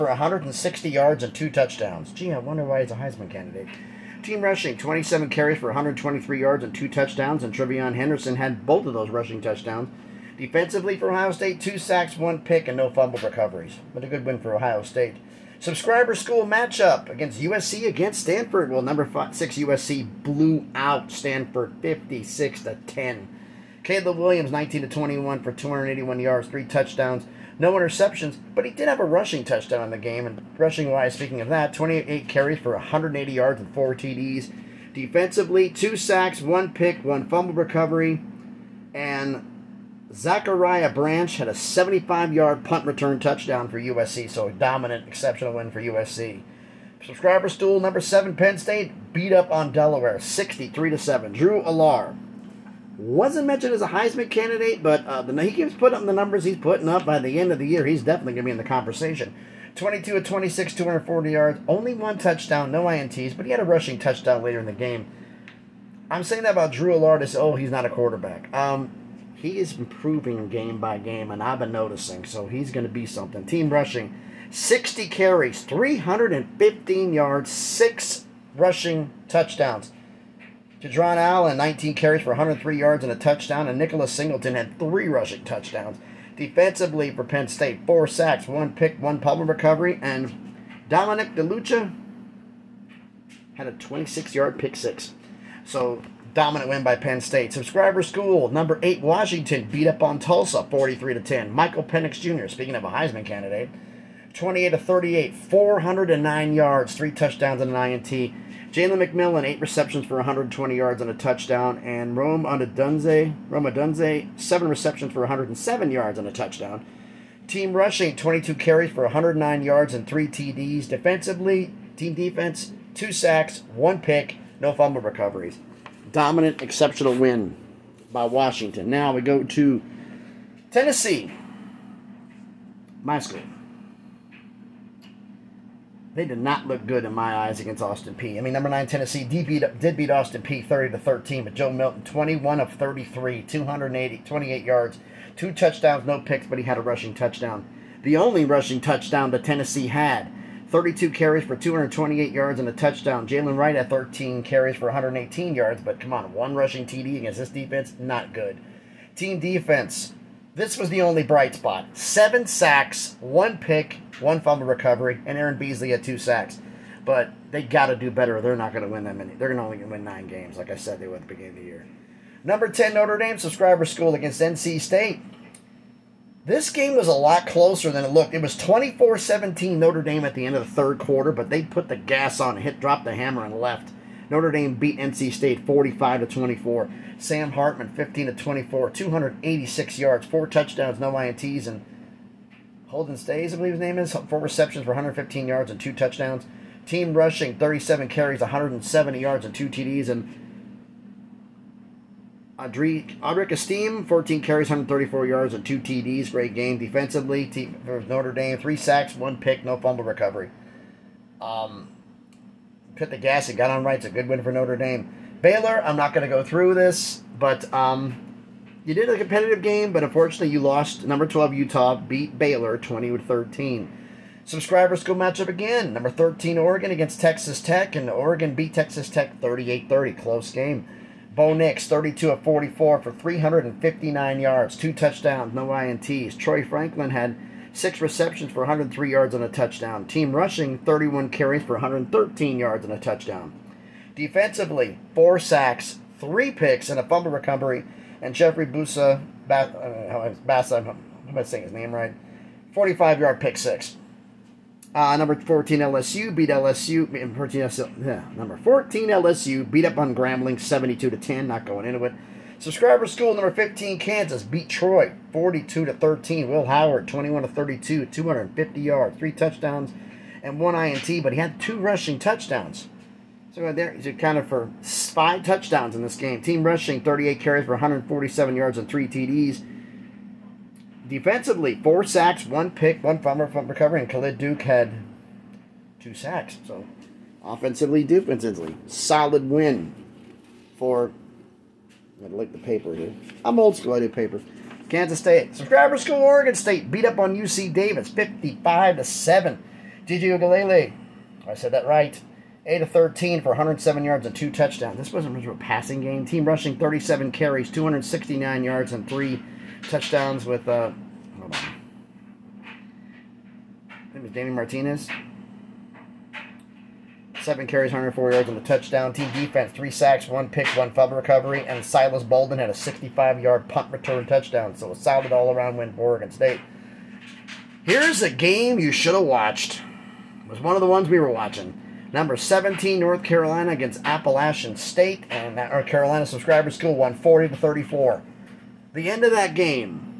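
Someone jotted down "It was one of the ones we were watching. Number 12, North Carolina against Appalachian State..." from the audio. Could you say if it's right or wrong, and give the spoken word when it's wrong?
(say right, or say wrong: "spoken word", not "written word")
wrong: "17", not "12".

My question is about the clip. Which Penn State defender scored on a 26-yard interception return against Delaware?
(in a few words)
Dominic DeLuca.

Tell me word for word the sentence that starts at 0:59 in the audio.
22 of 26, 240 yards, only one touchdown, no ints, but he had a rushing touchdown later in the game.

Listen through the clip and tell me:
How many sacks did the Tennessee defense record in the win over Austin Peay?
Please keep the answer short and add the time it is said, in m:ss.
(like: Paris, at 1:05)
7, at 2:41.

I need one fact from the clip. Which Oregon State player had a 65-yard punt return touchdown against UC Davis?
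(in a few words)
Silas Bolden.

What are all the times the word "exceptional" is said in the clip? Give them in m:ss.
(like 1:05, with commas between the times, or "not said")
0:45, 2:06.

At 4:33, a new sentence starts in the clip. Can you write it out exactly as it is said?
So uh, there, there, kind accounted for five touchdowns in this game.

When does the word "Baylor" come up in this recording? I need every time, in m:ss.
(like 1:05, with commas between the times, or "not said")
3:35, 3:42.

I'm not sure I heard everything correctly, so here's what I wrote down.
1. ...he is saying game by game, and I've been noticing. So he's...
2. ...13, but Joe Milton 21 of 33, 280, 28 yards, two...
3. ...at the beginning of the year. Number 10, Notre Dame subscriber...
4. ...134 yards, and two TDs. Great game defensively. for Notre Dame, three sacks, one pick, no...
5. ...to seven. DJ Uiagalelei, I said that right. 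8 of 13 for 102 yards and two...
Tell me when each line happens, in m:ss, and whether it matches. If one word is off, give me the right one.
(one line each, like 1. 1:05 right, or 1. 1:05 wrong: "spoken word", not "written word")
1. 1:09 wrong: "improving", not "saying"
2. 2:20 right
3. 2:51 right
4. 3:24 right
5. 4:58 wrong: "107", not "102".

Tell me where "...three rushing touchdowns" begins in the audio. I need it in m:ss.
1:24.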